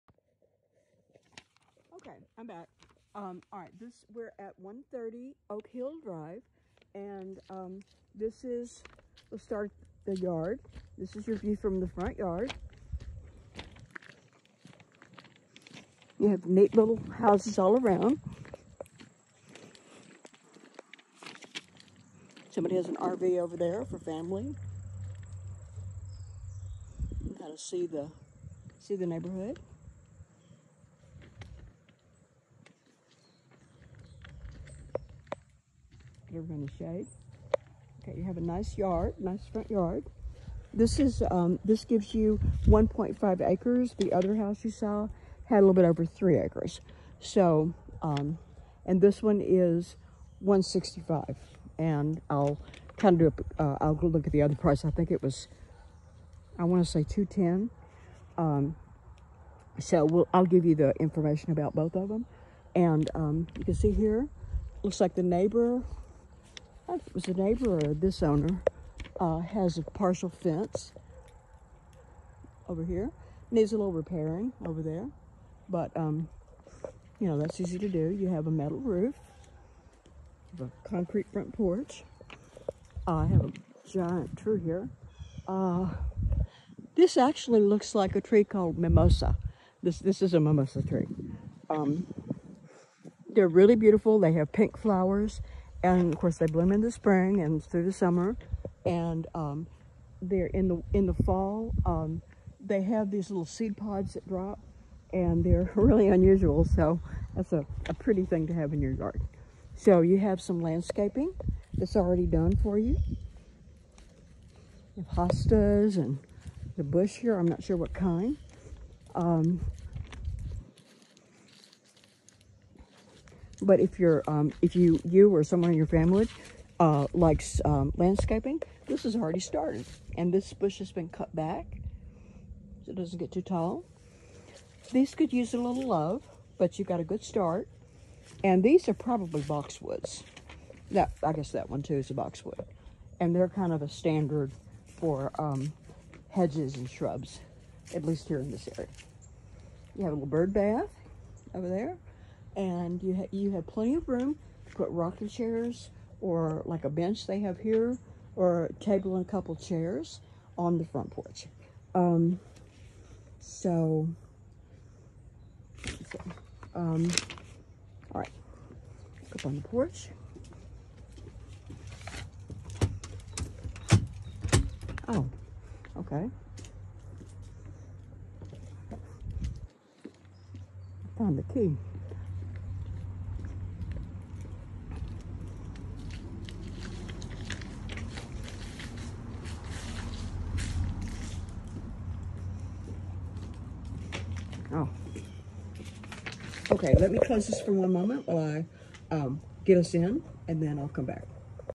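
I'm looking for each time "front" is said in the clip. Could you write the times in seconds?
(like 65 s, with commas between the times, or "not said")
11 s, 39 s, 81 s, 160 s.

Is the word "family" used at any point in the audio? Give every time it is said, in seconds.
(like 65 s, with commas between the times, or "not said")
23 s, 125 s.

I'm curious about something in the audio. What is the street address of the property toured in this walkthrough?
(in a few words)
130 Oak Hill Drive.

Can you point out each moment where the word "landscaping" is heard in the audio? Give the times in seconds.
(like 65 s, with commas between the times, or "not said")
110 s, 127 s.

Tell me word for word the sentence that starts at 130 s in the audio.
And this bush has been cut back so it doesn't get too tall.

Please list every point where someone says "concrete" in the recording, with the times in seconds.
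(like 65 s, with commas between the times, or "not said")
80 s.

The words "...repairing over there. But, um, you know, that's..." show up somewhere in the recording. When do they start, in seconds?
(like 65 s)
73 s.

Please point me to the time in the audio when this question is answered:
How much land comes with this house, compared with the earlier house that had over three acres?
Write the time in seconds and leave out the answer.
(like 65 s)
42 s.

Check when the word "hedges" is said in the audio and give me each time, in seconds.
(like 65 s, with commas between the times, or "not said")
146 s.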